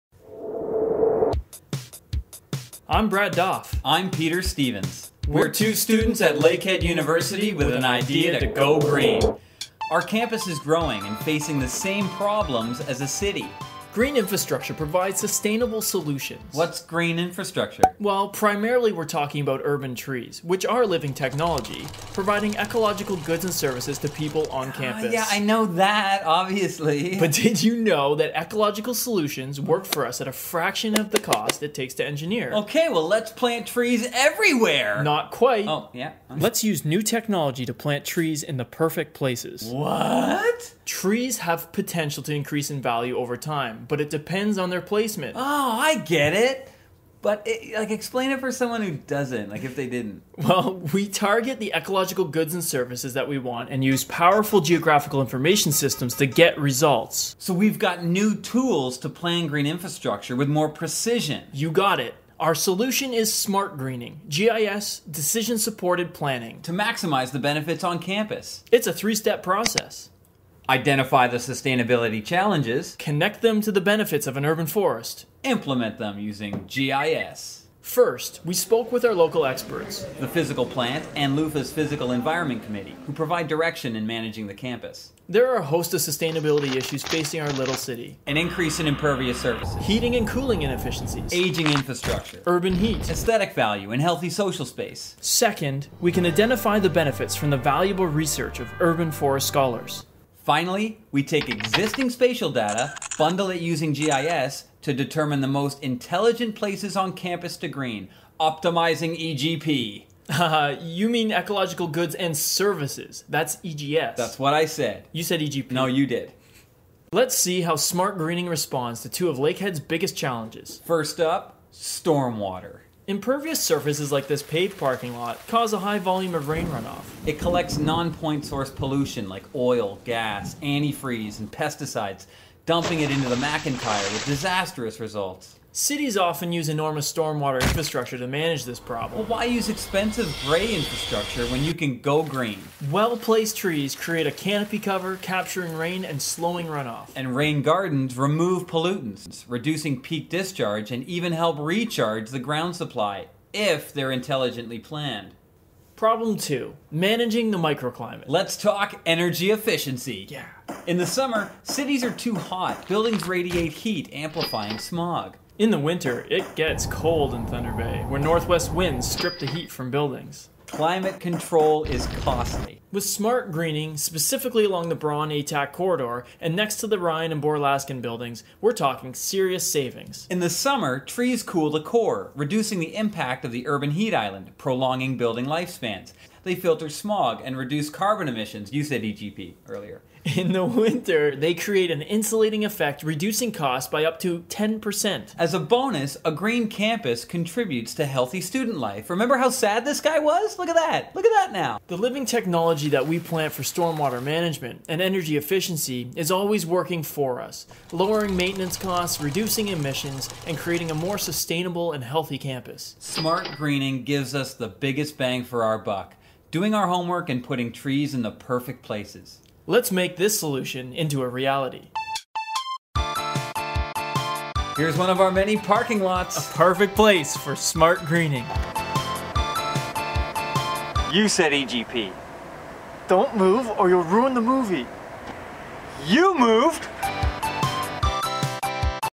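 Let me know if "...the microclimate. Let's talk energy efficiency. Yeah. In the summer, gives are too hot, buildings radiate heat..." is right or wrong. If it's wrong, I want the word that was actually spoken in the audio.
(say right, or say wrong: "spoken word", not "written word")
wrong: "cities", not "gives".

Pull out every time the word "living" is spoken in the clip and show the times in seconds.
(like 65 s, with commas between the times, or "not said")
20 s, 201 s.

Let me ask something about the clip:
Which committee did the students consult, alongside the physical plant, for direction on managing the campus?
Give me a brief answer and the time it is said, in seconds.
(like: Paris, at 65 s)
Physical Environment Committee, at 81 s.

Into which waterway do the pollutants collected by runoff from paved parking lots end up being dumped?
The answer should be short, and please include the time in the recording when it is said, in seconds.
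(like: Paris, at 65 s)
the McIntyre, at 133 s.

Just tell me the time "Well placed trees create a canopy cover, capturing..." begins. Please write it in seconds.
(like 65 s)
142 s.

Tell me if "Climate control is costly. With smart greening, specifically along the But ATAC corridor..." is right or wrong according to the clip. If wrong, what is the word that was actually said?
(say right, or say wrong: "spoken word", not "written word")
wrong: "Braun", not "But".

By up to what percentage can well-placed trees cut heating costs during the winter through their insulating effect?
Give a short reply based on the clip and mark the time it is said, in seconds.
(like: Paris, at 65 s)
10%, at 194 s.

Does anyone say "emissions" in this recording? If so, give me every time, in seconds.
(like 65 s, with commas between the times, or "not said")
188 s, 209 s.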